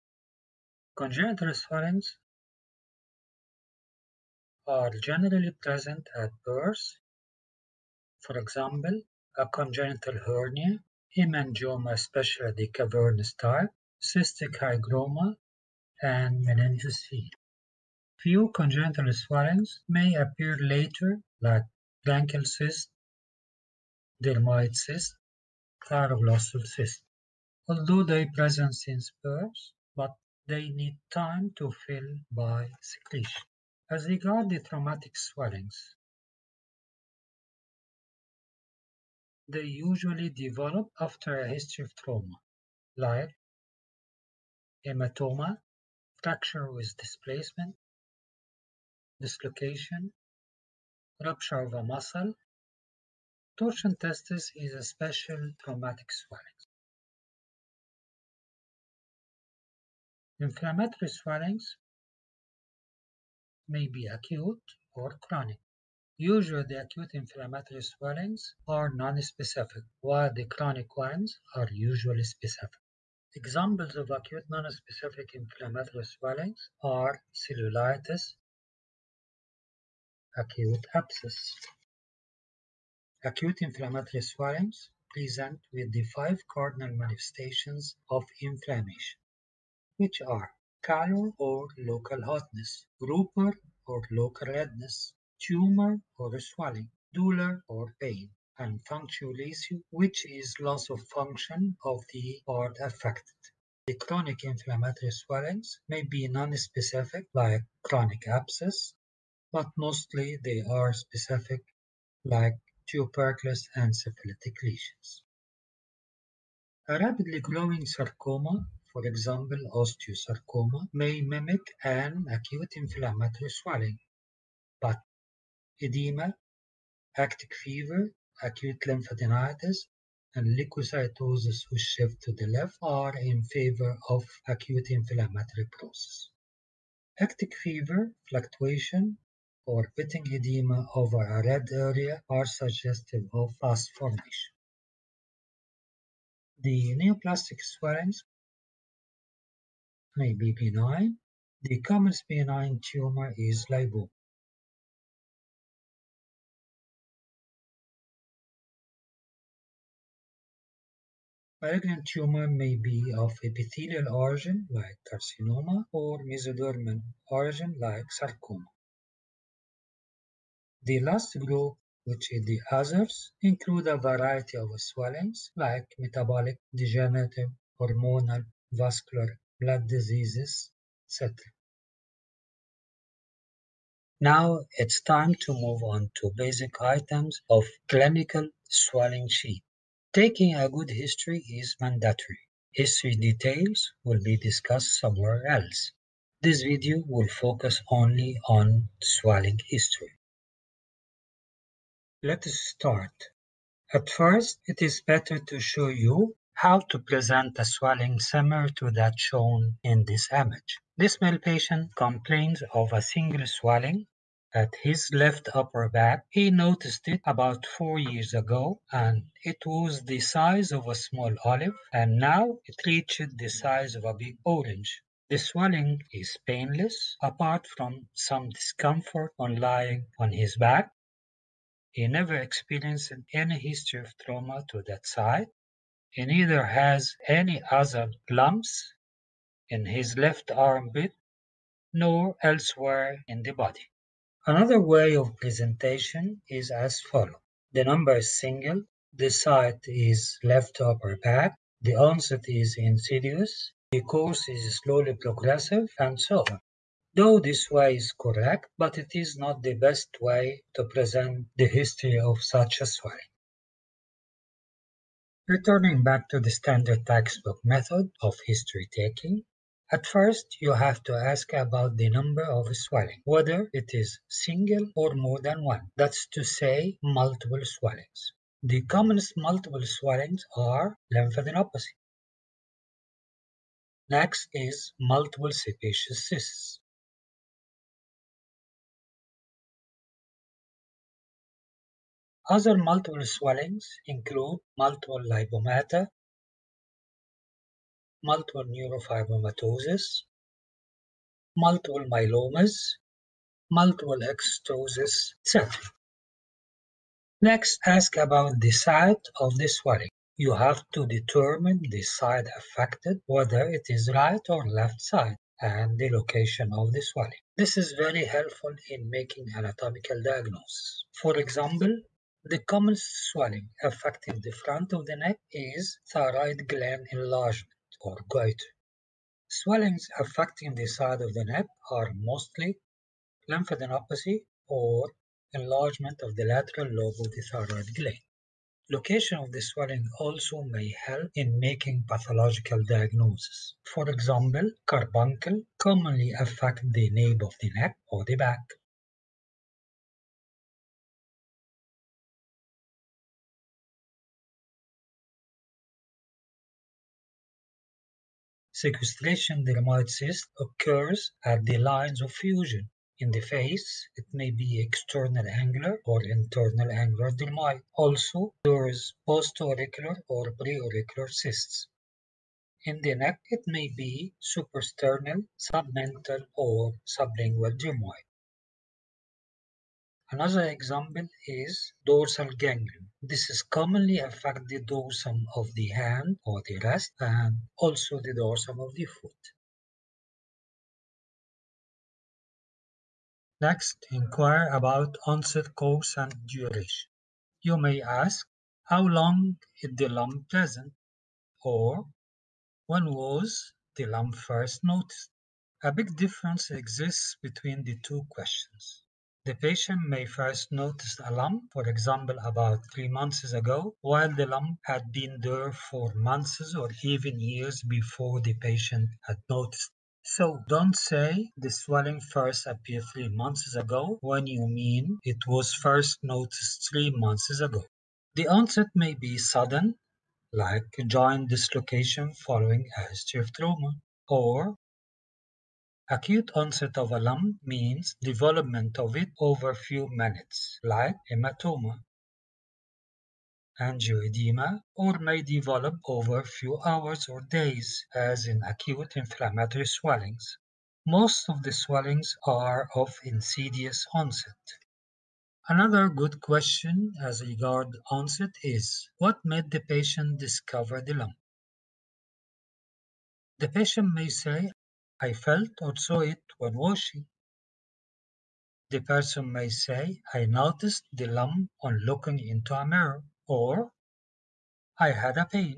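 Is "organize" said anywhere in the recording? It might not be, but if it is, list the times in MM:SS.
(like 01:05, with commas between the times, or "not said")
not said.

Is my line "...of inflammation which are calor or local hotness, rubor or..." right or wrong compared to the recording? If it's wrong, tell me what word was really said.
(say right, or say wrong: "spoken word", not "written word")
right.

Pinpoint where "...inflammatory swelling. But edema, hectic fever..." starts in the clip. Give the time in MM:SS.
02:02.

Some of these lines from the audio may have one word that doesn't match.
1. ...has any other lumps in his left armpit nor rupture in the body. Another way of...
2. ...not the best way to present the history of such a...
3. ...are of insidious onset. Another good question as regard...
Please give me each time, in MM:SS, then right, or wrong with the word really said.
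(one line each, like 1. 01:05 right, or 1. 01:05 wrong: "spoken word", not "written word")
1. 03:56 wrong: "elsewhere", not "rupture"
2. 04:19 right
3. 07:32 right.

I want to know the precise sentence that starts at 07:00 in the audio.
So don't say the swelling first appeared three months ago when you mean it was first noticed three months ago.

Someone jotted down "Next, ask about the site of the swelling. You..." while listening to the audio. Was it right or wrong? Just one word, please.
right.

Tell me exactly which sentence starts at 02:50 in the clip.
The last group, which is the others, include a variety of swellings like metabolic, degenerative, hormonal, vascular, blood diseases, etc.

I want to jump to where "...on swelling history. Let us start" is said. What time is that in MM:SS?
03:18.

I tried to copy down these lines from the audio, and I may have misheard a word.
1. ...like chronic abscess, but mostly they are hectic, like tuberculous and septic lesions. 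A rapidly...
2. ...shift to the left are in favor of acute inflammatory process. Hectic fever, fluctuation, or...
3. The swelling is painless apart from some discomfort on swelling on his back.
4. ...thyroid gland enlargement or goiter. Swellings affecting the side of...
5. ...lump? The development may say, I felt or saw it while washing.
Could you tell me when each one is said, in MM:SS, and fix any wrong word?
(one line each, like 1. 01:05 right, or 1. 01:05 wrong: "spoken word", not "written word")
1. 01:47 wrong: "specific", not "hectic"
2. 02:11 right
3. 03:45 wrong: "lying", not "swelling"
4. 05:26 right
5. 07:41 wrong: "patient", not "development".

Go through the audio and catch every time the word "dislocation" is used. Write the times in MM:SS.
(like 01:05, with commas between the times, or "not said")
00:49, 07:11.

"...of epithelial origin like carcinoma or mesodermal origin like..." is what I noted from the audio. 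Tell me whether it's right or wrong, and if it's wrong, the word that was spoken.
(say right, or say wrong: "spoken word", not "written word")
right.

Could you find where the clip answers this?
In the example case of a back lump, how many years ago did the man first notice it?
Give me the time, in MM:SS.
03:37.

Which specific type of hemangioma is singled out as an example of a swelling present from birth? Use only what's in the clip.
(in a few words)
Cavernous.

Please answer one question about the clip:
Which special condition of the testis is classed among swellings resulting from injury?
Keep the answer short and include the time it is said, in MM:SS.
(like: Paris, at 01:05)
Torsion testis, at 00:53.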